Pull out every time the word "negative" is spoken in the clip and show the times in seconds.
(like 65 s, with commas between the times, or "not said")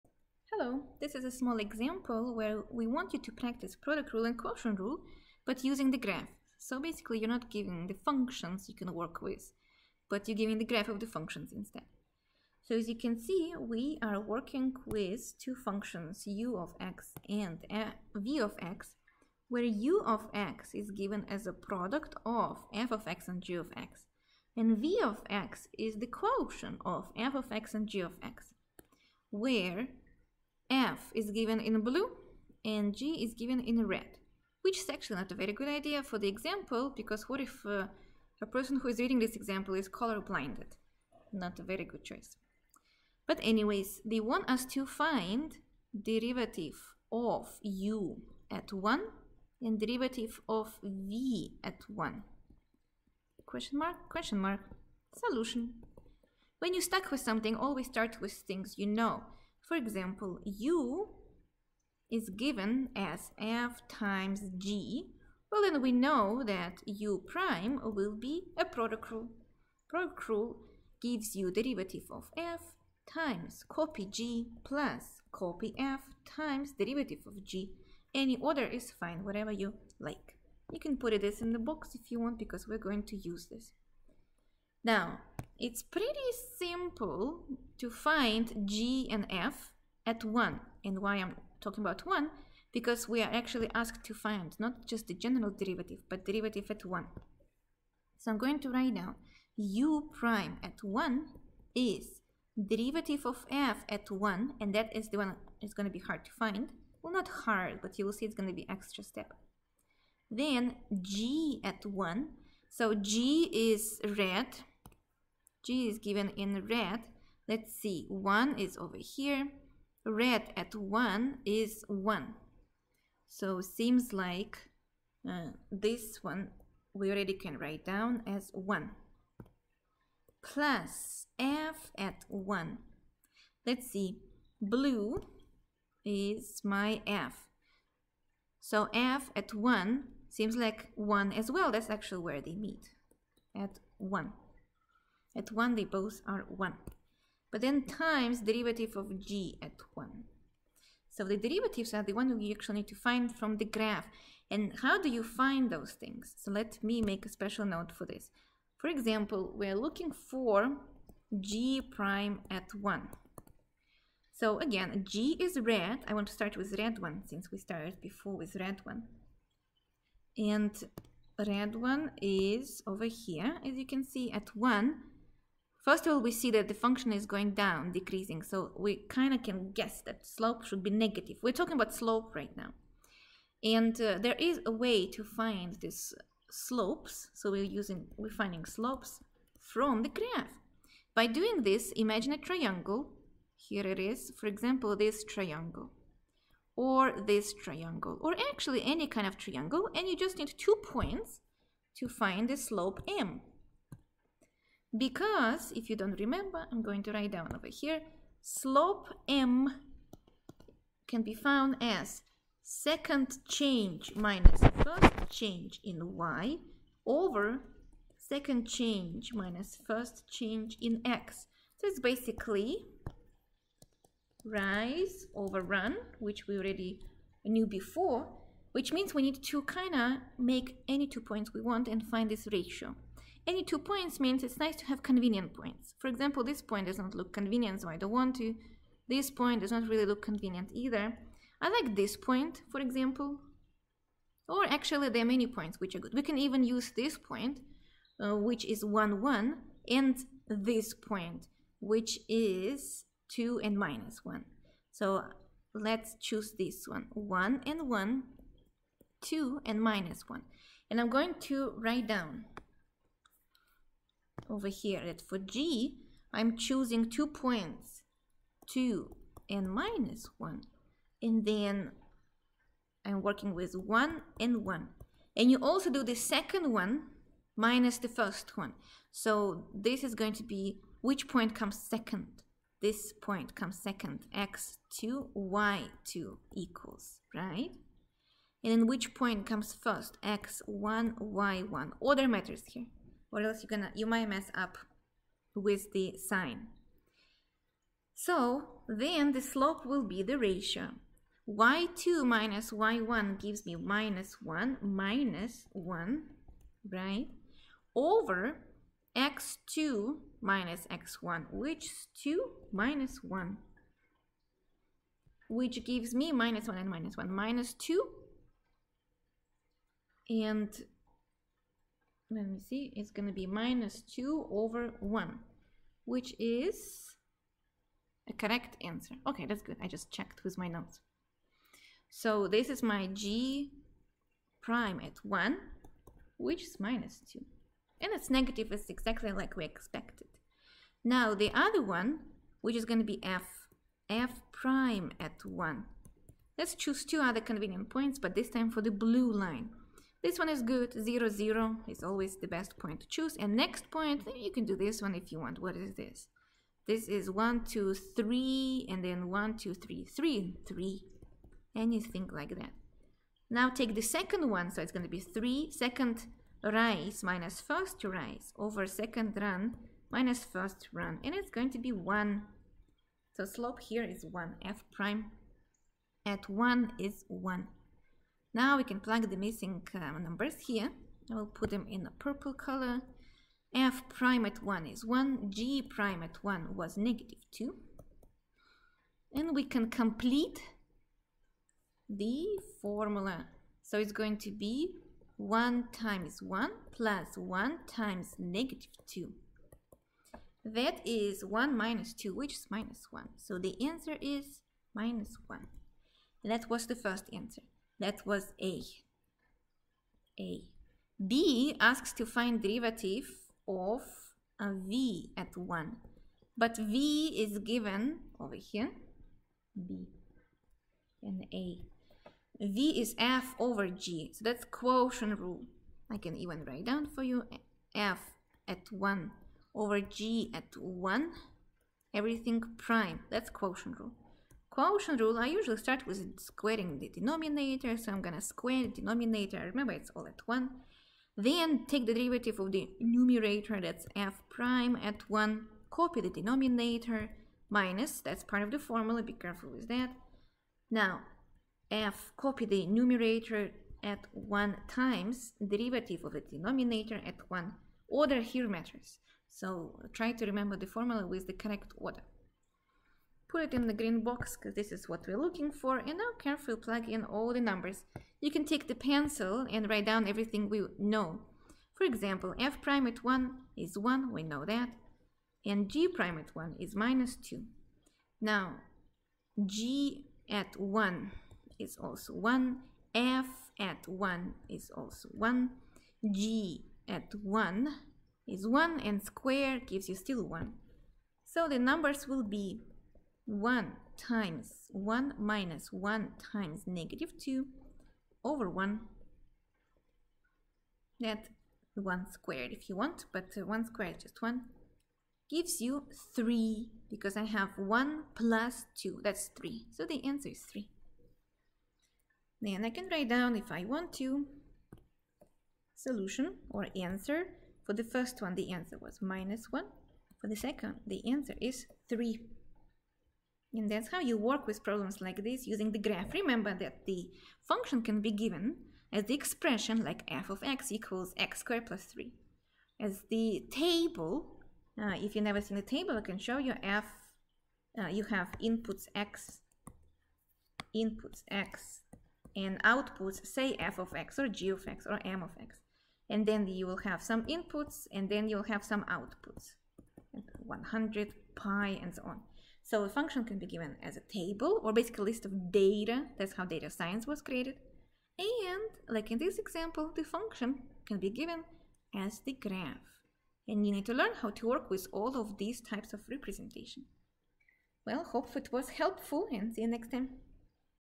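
180 s, 338 s, 386 s, 398 s, 496 s.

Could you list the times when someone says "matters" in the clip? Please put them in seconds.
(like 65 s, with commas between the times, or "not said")
292 s, 458 s.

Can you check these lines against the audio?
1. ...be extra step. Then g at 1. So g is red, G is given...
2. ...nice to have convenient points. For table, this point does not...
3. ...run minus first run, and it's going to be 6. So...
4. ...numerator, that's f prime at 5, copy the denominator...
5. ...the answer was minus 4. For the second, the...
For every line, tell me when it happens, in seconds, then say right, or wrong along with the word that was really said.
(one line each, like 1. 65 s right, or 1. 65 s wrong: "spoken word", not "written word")
1. 108 s right
2. 234 s wrong: "example", not "table"
3. 369 s wrong: "1", not "6"
4. 443 s wrong: "1", not "5"
5. 518 s wrong: "1", not "4".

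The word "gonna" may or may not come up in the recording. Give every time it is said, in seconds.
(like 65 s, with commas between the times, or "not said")
293 s, 438 s.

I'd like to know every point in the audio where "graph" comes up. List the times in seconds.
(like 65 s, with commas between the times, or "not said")
5 s, 10 s, 153 s, 190 s, 525 s, 562 s.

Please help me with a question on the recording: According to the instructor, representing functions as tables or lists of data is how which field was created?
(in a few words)
Data science.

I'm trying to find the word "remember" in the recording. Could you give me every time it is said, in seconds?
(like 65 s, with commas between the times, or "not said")
206 s, 439 s, 460 s, 526 s.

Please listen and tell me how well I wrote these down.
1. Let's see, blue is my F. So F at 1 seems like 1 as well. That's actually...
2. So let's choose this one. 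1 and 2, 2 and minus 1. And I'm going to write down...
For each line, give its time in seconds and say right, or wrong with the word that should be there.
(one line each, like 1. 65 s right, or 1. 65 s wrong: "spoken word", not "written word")
1. 133 s right
2. 254 s wrong: "1", not "2".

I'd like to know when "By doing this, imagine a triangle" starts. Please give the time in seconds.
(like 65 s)
191 s.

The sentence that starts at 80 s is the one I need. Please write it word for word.
You can put this in the box if you want because we're going to use this.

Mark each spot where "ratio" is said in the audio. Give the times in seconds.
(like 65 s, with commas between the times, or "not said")
232 s, 300 s.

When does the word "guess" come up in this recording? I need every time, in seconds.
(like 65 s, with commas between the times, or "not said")
179 s.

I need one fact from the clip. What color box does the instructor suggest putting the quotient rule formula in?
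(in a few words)
Green.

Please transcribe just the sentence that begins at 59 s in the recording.
For example, u is given as f times g.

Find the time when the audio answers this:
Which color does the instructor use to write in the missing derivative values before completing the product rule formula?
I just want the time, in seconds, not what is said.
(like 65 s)
382 s.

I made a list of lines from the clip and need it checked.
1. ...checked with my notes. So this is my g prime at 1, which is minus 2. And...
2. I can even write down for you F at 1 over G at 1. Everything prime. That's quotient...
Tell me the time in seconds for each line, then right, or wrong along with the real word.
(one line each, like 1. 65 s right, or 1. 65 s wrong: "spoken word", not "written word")
1. 330 s right
2. 426 s right.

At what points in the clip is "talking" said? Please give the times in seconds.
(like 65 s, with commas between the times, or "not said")
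91 s, 181 s.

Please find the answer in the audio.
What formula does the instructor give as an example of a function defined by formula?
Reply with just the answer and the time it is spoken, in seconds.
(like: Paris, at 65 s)
x squared plus 3, at 531 s.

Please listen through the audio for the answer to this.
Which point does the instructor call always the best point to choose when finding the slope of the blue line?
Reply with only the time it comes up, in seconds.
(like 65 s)
350 s.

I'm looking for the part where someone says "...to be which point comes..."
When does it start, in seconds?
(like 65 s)
280 s.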